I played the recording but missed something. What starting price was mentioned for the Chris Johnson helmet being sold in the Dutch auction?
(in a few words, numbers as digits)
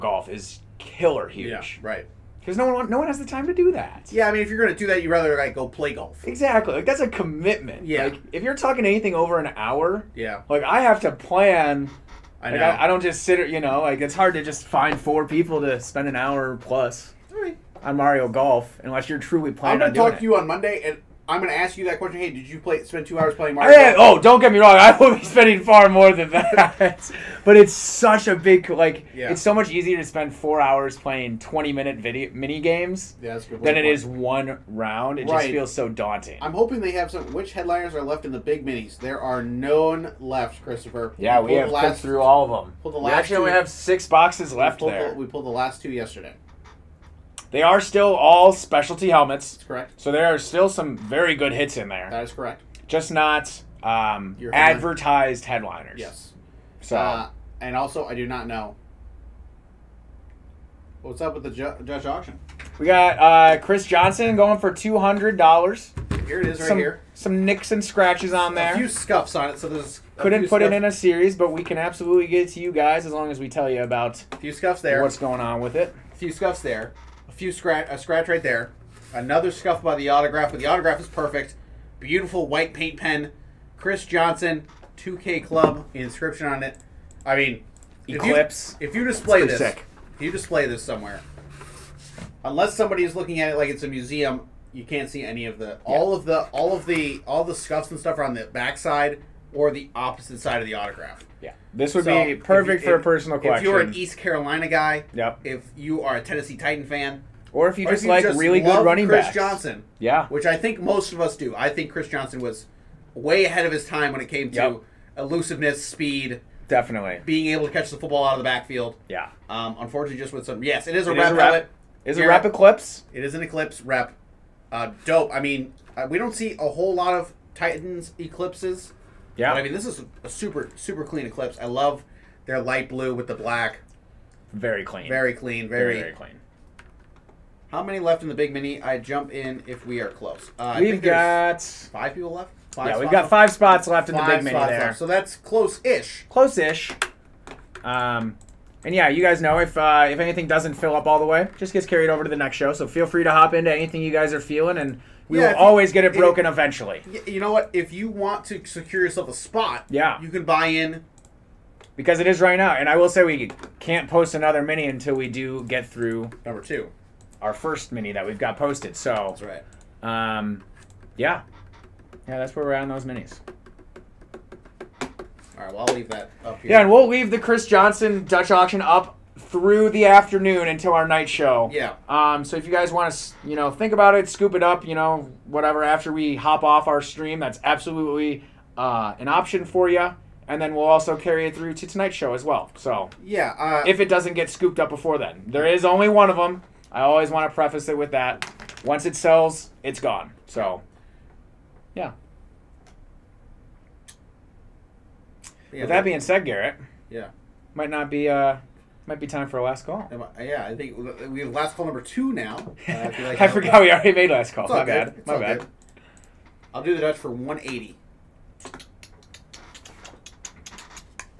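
$200.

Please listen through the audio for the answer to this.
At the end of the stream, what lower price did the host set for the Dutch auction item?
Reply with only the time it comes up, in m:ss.
3:37.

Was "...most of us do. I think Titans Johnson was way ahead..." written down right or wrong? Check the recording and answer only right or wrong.
wrong.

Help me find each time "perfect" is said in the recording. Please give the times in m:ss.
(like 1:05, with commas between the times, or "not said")
1:21, 1:42.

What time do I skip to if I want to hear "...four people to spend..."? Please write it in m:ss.
0:14.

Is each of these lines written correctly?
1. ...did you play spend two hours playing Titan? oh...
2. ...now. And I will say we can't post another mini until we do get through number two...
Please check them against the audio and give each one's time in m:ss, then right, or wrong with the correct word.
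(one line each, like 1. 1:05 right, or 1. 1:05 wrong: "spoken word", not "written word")
1. 0:22 wrong: "Mario", not "Titan"
2. 2:42 right.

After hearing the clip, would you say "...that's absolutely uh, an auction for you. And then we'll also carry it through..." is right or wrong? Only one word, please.
wrong.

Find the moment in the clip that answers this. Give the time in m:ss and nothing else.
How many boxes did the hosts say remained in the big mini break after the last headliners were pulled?
0:43.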